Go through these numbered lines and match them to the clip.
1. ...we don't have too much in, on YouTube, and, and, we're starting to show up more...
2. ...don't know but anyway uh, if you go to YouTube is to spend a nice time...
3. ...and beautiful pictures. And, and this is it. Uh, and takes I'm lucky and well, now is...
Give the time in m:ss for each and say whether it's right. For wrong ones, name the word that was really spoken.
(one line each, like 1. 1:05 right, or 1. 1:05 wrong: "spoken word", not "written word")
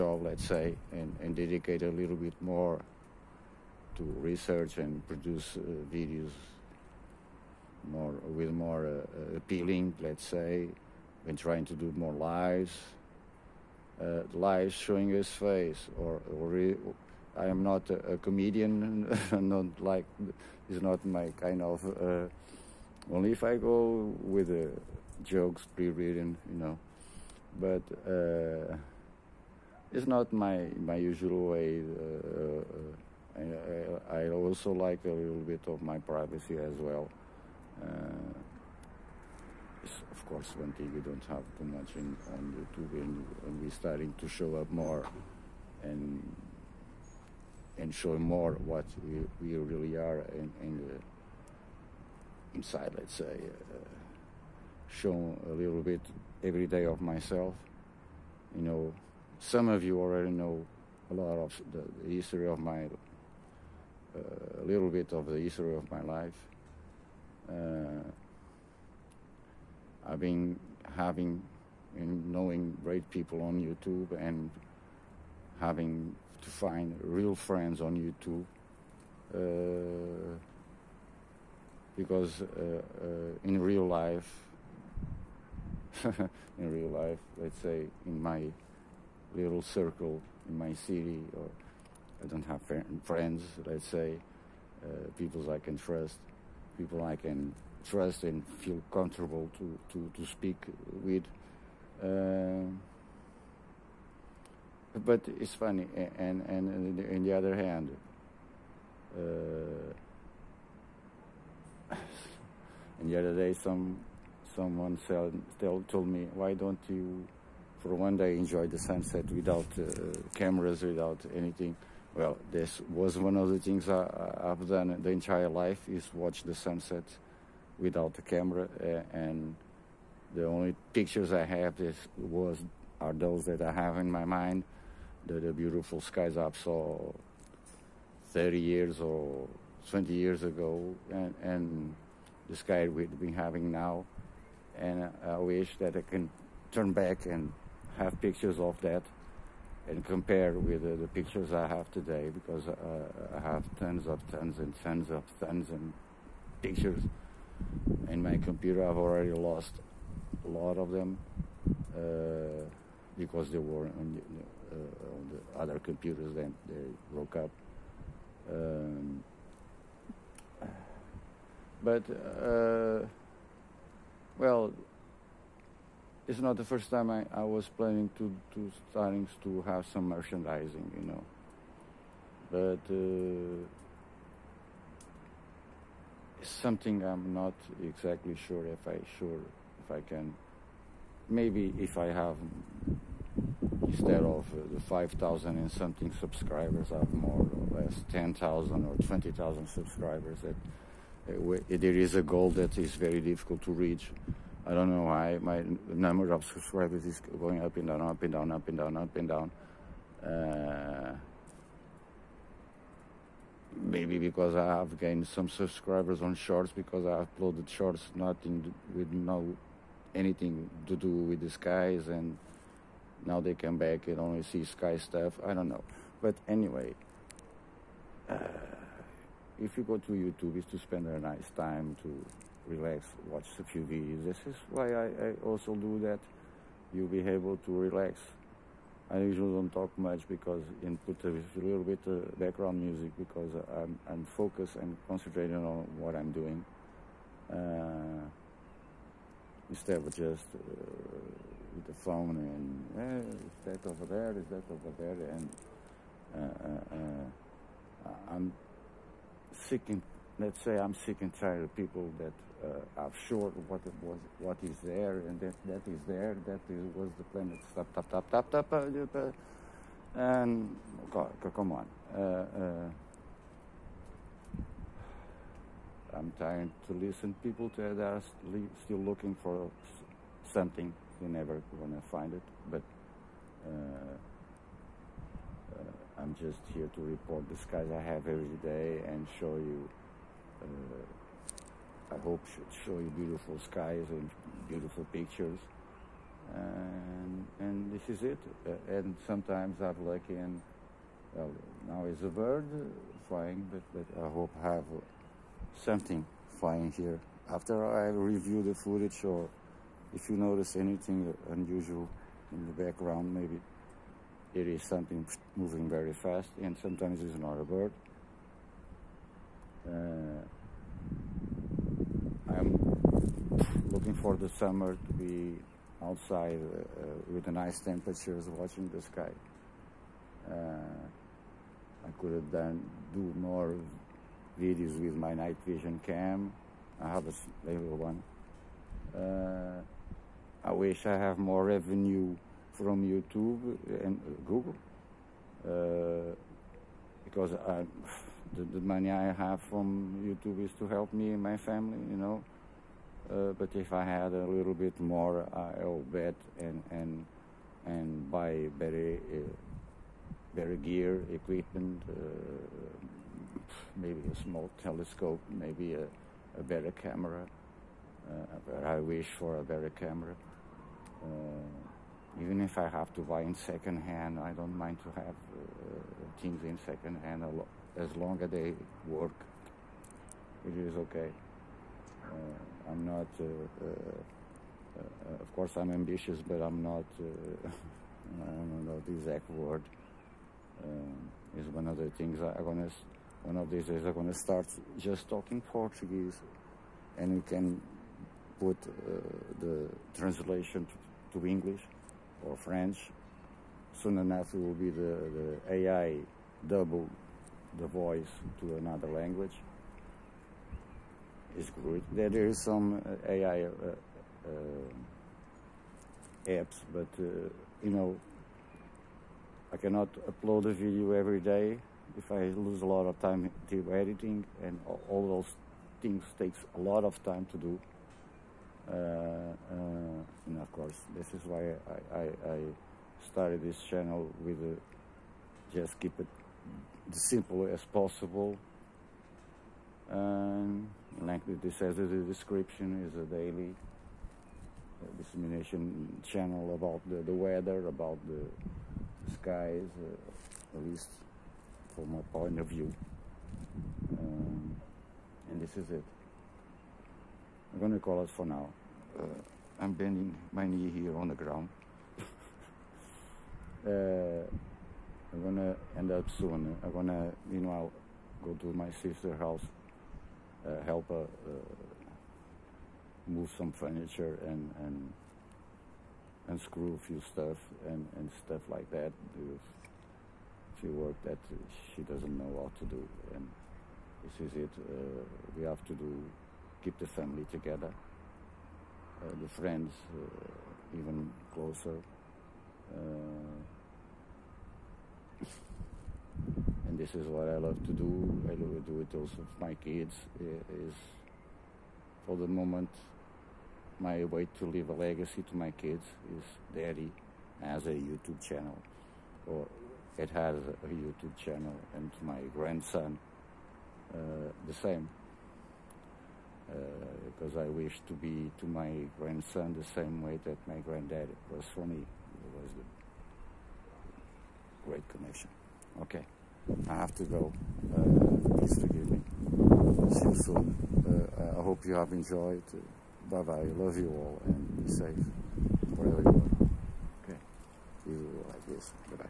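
1. 0:40 right
2. 3:45 right
3. 4:54 wrong: "sometimes", not "takes".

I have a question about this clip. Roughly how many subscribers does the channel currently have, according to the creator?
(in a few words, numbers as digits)
5,000.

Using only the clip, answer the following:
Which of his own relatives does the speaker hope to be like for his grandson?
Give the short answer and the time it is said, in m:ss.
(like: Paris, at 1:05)
granddad, at 8:40.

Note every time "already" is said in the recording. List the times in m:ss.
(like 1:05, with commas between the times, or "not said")
0:59, 2:38.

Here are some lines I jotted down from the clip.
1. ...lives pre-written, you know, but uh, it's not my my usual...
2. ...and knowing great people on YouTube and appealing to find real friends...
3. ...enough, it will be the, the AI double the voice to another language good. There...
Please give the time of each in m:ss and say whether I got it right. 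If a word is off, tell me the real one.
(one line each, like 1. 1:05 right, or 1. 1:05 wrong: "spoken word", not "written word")
1. 0:25 wrong: "jokes", not "lives"
2. 1:11 wrong: "having", not "appealing"
3. 6:44 right.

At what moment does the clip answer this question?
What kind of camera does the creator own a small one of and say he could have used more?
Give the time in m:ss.
5:35.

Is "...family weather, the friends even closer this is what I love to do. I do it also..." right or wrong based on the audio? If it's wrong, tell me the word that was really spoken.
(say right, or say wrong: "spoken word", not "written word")
wrong: "together", not "weather".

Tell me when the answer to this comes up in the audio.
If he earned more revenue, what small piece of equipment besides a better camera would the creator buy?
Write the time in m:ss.
6:04.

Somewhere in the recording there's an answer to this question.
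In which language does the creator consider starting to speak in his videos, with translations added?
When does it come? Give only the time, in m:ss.
6:35.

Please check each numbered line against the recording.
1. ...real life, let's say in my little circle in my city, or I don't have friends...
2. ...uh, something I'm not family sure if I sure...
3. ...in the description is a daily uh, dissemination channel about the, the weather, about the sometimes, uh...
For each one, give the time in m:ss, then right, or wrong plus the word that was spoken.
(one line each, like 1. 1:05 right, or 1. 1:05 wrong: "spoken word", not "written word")
1. 1:26 right
2. 3:02 wrong: "exactly", not "family"
3. 7:21 wrong: "skies", not "sometimes".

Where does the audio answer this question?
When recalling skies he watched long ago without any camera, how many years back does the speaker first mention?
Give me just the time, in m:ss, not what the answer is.
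2:18.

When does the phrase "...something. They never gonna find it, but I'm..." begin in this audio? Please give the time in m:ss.
4:40.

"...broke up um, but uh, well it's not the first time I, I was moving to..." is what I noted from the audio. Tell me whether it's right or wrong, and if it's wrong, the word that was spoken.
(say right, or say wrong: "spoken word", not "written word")
wrong: "planning", not "moving".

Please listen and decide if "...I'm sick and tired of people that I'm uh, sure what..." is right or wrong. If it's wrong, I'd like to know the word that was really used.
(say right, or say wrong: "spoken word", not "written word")
right.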